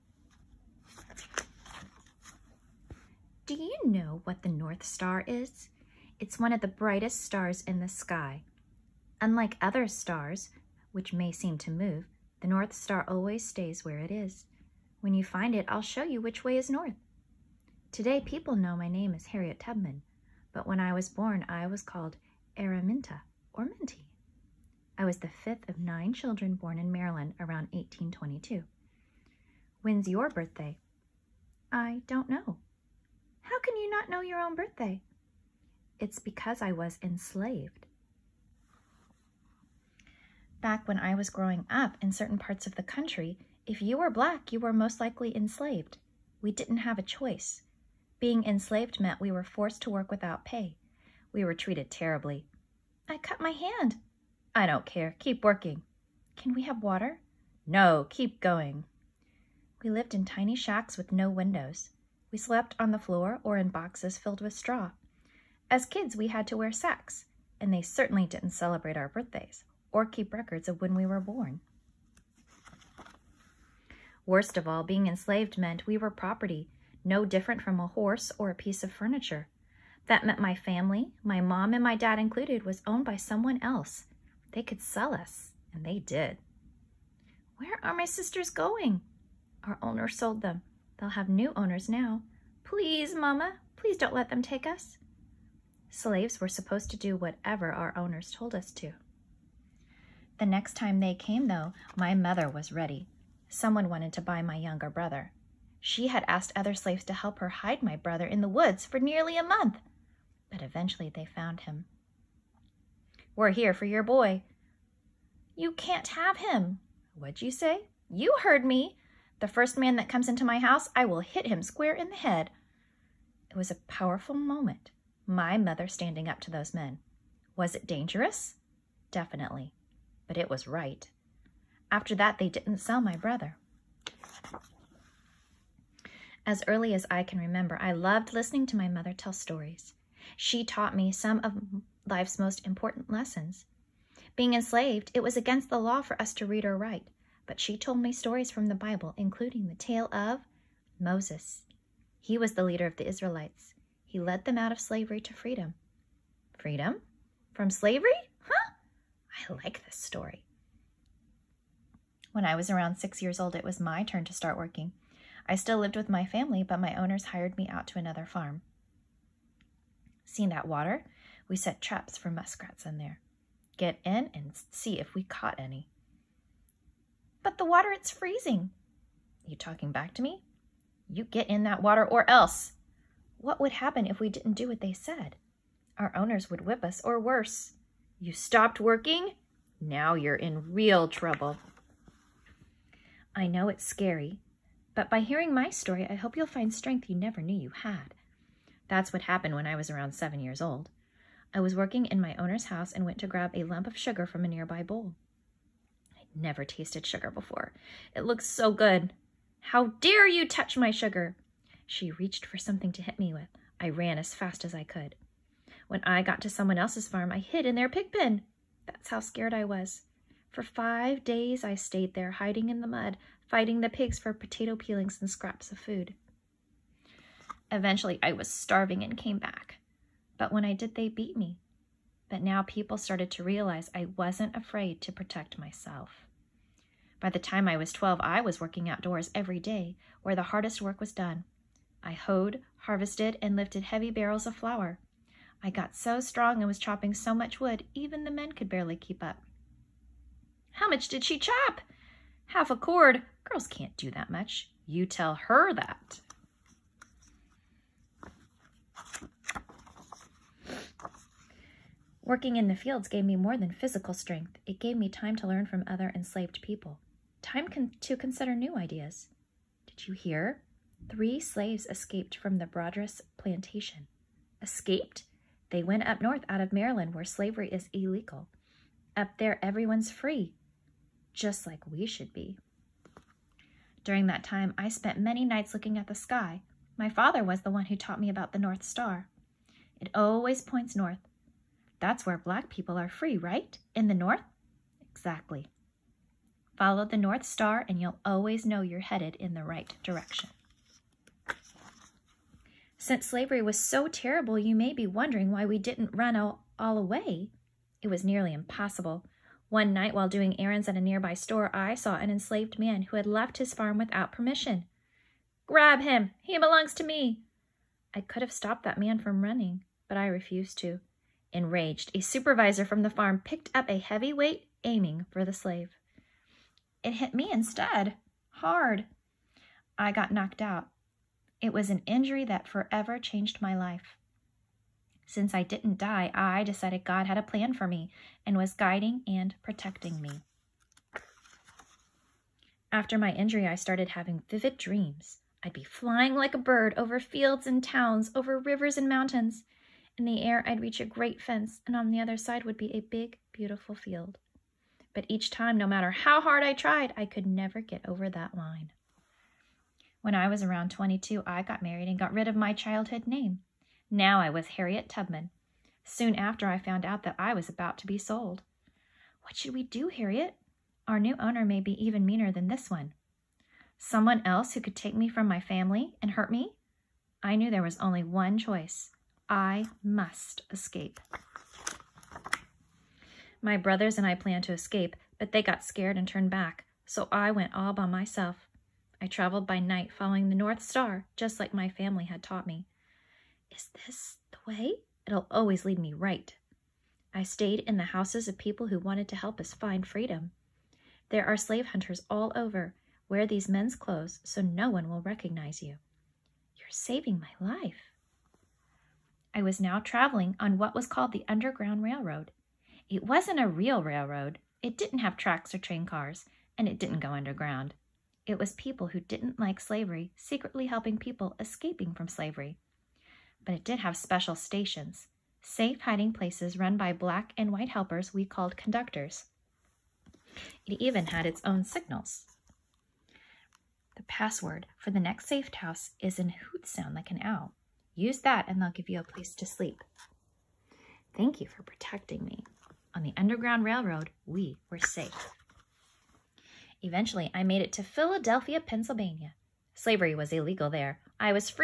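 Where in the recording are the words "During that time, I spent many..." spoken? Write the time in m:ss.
4:44.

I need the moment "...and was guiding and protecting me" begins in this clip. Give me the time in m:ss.
5:38.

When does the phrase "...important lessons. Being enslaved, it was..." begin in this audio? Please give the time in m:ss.
2:22.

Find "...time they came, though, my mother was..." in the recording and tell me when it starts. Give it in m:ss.
1:40.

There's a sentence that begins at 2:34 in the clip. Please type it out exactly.
He led them out of slavery to freedom.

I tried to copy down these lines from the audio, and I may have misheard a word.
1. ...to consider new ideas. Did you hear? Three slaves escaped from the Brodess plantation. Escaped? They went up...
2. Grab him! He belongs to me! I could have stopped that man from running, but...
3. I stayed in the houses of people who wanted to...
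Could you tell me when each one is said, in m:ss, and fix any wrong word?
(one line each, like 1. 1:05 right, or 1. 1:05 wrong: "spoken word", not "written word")
1. 4:27 right
2. 5:15 right
3. 6:37 right.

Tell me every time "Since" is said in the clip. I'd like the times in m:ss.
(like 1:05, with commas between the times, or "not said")
5:03, 5:35.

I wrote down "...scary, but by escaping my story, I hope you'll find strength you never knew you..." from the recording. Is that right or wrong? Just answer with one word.
wrong.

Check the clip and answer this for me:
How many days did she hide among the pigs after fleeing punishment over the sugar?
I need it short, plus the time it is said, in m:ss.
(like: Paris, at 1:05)
5, at 3:40.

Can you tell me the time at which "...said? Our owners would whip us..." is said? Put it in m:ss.
3:04.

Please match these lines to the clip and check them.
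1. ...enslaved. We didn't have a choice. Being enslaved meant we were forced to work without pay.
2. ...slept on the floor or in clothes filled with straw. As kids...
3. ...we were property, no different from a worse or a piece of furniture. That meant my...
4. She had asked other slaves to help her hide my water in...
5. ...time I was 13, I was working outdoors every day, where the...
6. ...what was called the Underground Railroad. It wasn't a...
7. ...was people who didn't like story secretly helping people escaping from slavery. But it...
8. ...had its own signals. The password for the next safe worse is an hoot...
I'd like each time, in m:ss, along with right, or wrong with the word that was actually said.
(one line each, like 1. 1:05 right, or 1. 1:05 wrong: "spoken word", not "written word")
1. 0:45 right
2. 1:02 wrong: "boxes", not "clothes"
3. 1:15 wrong: "horse", not "worse"
4. 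1:45 wrong: "brother", not "water"
5. 3:57 wrong: "12", not "13"
6. 6:50 right
7. 6:58 wrong: "slavery", not "story"
8. 7:11 wrong: "house", not "worse".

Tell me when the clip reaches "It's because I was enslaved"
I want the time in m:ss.
0:35.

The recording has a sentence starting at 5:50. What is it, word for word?
In the air, I'd reach a great fence, and on the other side would be a big, beautiful field.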